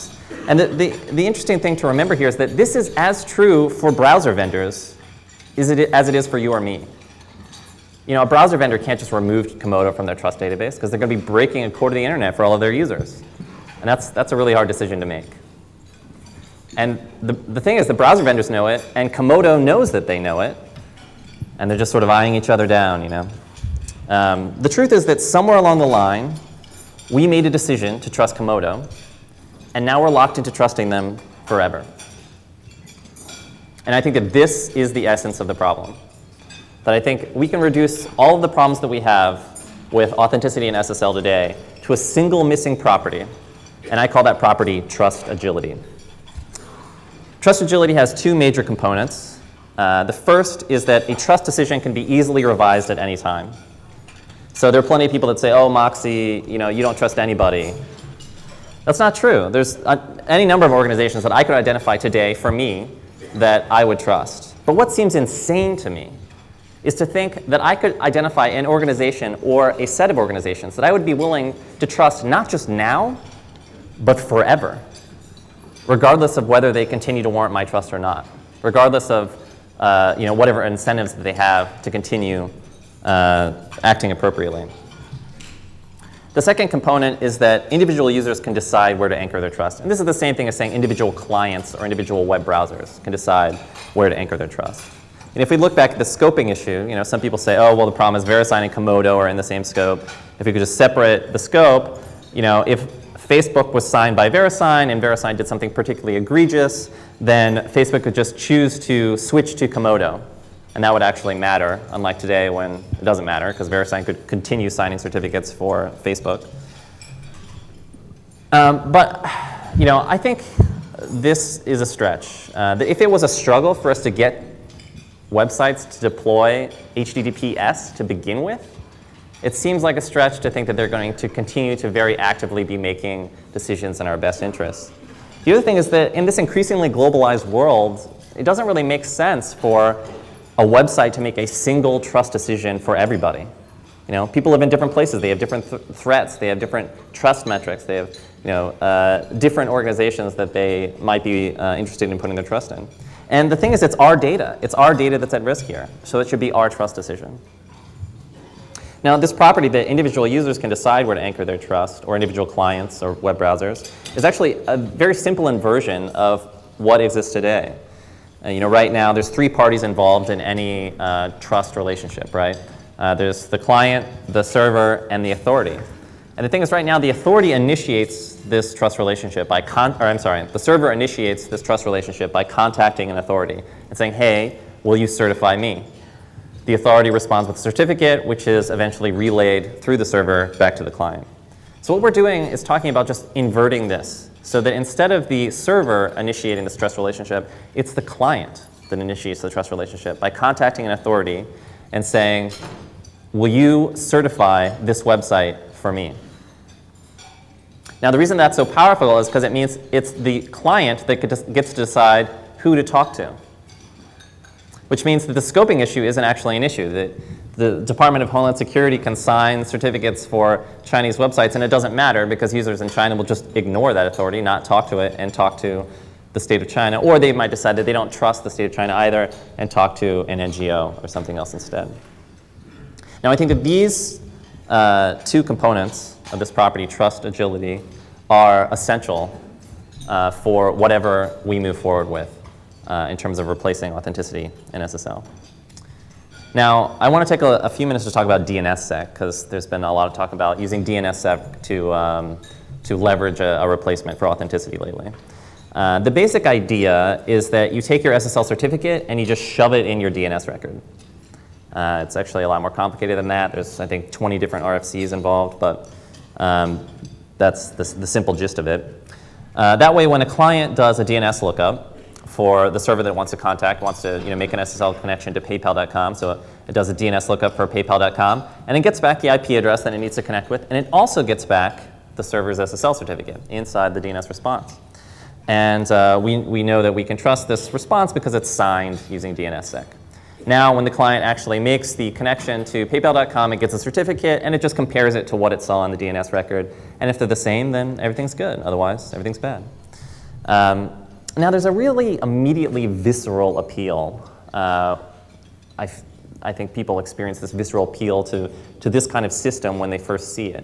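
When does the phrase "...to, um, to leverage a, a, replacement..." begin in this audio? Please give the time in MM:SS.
04:11.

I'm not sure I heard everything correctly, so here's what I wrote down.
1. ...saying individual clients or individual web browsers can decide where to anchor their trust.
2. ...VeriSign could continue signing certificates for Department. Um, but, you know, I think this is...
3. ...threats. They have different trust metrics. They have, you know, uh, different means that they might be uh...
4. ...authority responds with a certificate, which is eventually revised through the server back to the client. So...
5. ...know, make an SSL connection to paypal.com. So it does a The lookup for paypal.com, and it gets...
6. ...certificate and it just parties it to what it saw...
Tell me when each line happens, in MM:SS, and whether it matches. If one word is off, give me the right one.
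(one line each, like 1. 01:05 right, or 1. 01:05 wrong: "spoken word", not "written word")
1. 01:30 right
2. 01:53 wrong: "Facebook", not "Department"
3. 02:25 wrong: "organizations", not "means"
4. 03:06 wrong: "relayed", not "revised"
5. 04:34 wrong: "DNS", not "The"
6. 04:53 wrong: "compares", not "parties".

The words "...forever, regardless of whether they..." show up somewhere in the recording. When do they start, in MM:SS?
01:14.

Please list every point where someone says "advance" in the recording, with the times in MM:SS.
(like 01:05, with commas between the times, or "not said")
not said.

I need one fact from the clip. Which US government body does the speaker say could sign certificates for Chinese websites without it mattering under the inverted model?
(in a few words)
Department of Homeland Security.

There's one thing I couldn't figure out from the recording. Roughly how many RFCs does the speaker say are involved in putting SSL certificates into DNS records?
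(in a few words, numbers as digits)
20.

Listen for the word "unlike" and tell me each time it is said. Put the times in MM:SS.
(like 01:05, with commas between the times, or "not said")
01:51.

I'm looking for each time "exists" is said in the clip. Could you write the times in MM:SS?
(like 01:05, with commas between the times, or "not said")
02:47.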